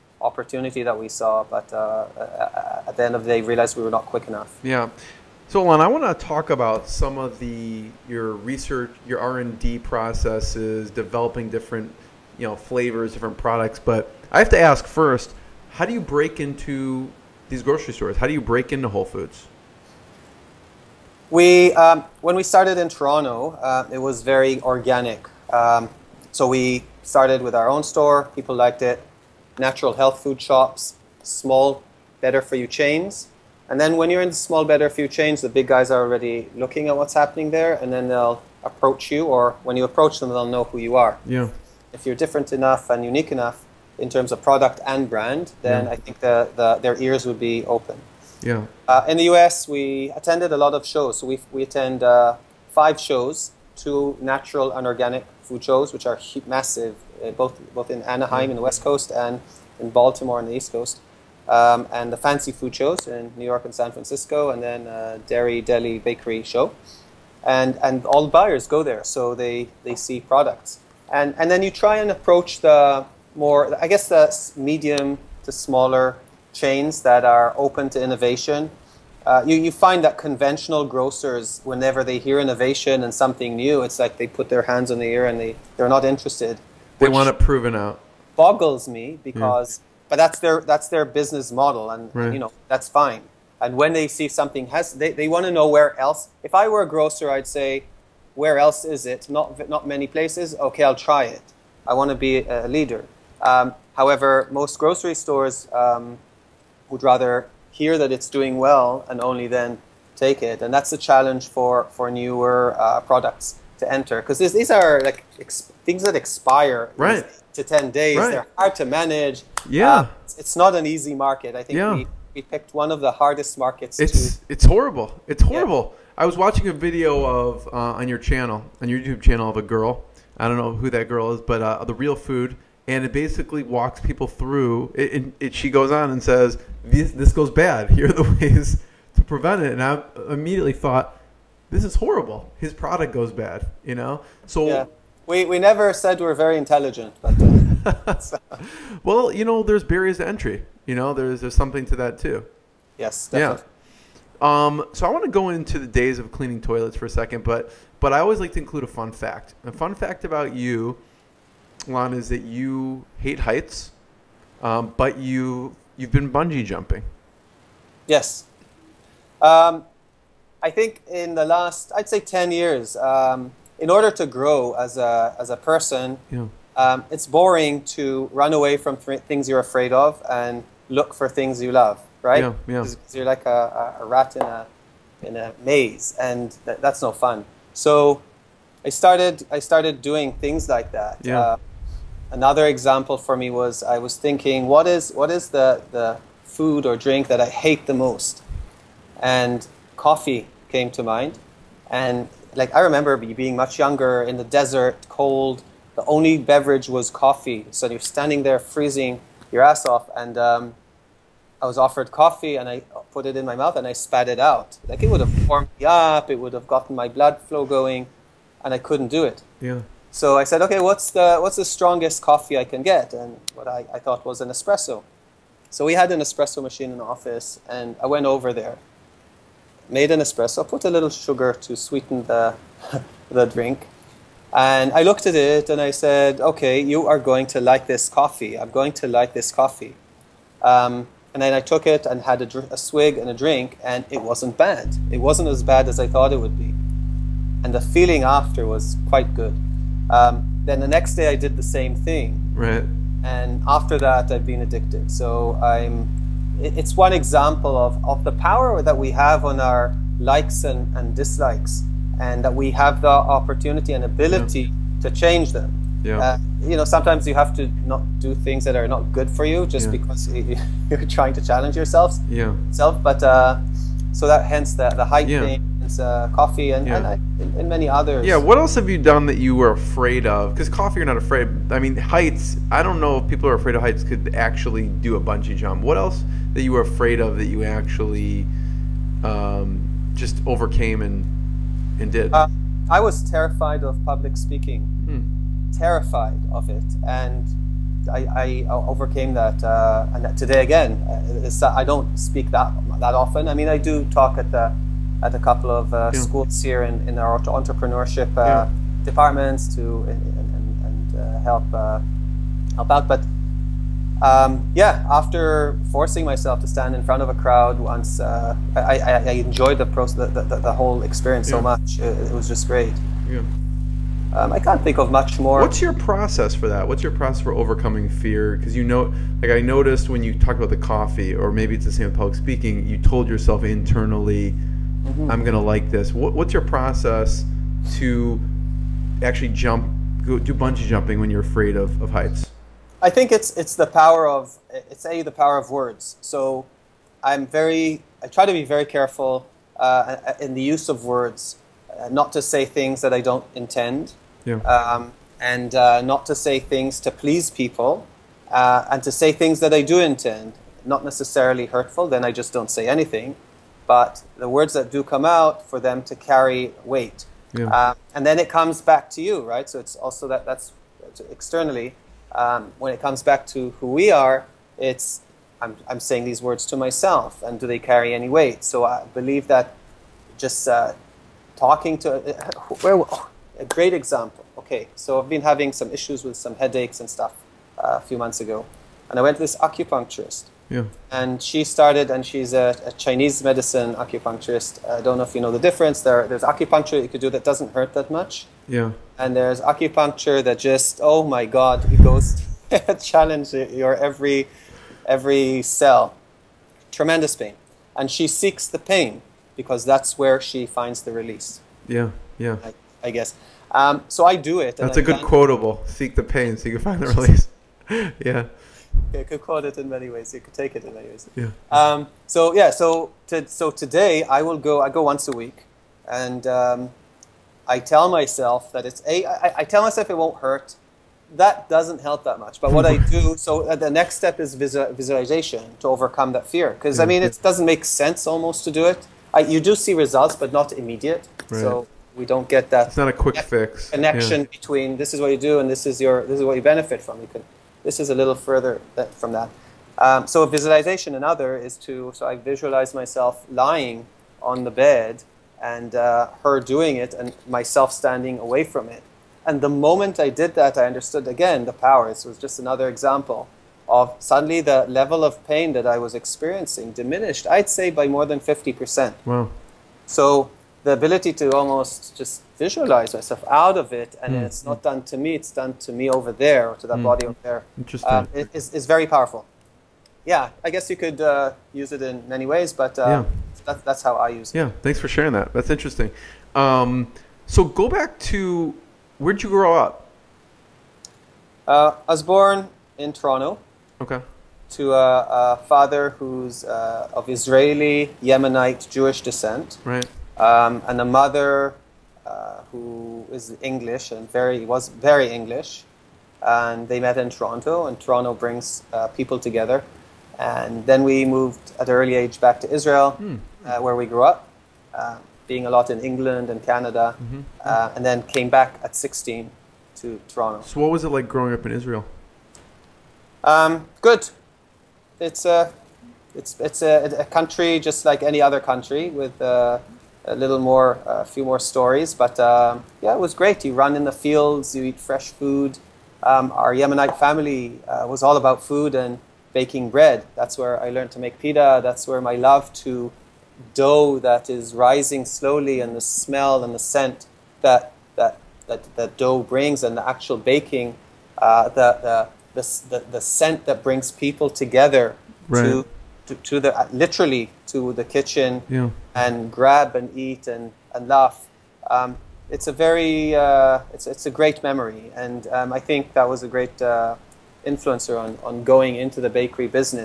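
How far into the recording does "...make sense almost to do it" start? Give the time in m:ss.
7:17.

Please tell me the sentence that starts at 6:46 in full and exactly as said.
Tremendous pain, and she seeks the pain because that's where she finds the release.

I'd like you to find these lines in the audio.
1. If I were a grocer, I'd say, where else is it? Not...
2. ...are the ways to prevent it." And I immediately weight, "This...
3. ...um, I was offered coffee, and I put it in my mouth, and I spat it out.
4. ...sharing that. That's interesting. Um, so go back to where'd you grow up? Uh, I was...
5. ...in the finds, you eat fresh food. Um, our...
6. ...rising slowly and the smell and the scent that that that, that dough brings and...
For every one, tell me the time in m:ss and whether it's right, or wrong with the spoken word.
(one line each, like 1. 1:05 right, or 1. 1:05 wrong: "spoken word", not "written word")
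1. 1:36 right
2. 2:18 wrong: "thought", not "weight"
3. 3:30 right
4. 8:05 right
5. 8:53 wrong: "fields", not "finds"
6. 9:04 right.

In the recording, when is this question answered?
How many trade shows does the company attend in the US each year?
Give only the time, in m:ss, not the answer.
0:52.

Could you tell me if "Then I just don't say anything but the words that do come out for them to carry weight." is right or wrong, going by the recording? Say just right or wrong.
right.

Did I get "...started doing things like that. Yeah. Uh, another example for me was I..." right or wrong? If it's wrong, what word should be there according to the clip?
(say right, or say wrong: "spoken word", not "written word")
right.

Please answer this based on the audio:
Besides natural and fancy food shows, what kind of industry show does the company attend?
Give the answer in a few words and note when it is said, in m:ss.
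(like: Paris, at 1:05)
Dairy Deli Bakery show, at 1:05.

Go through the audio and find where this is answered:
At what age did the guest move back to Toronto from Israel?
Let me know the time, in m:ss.
8:38.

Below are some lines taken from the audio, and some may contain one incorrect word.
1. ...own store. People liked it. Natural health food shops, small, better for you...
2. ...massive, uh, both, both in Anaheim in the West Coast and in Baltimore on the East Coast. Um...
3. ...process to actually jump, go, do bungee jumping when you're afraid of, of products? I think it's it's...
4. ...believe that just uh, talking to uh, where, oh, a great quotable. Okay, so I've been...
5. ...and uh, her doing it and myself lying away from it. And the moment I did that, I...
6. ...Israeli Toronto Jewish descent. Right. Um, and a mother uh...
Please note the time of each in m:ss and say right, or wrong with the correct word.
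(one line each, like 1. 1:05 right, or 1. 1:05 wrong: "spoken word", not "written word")
1. 0:27 right
2. 0:56 right
3. 5:36 wrong: "heights", not "products"
4. 6:19 wrong: "example", not "quotable"
5. 7:35 wrong: "standing", not "lying"
6. 8:17 wrong: "Yemenite", not "Toronto".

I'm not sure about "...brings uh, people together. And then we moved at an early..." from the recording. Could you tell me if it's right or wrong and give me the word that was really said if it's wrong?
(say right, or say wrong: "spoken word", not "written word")
right.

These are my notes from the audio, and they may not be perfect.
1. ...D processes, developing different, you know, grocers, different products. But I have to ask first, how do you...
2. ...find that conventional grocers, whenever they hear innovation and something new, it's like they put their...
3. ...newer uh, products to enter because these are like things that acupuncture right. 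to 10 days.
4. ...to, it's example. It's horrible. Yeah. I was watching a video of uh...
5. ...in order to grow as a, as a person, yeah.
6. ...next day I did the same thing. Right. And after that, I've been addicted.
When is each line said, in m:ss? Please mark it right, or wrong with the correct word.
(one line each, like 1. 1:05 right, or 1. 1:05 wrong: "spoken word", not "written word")
1. 0:09 wrong: "flavors", not "grocers"
2. 1:19 right
3. 1:52 wrong: "expire", not "acupuncture"
4. 2:04 wrong: "horrible", not "example"
5. 2:53 right
6. 4:10 right.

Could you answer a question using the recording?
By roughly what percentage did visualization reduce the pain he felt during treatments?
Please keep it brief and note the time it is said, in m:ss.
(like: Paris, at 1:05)
More than 50%, at 7:48.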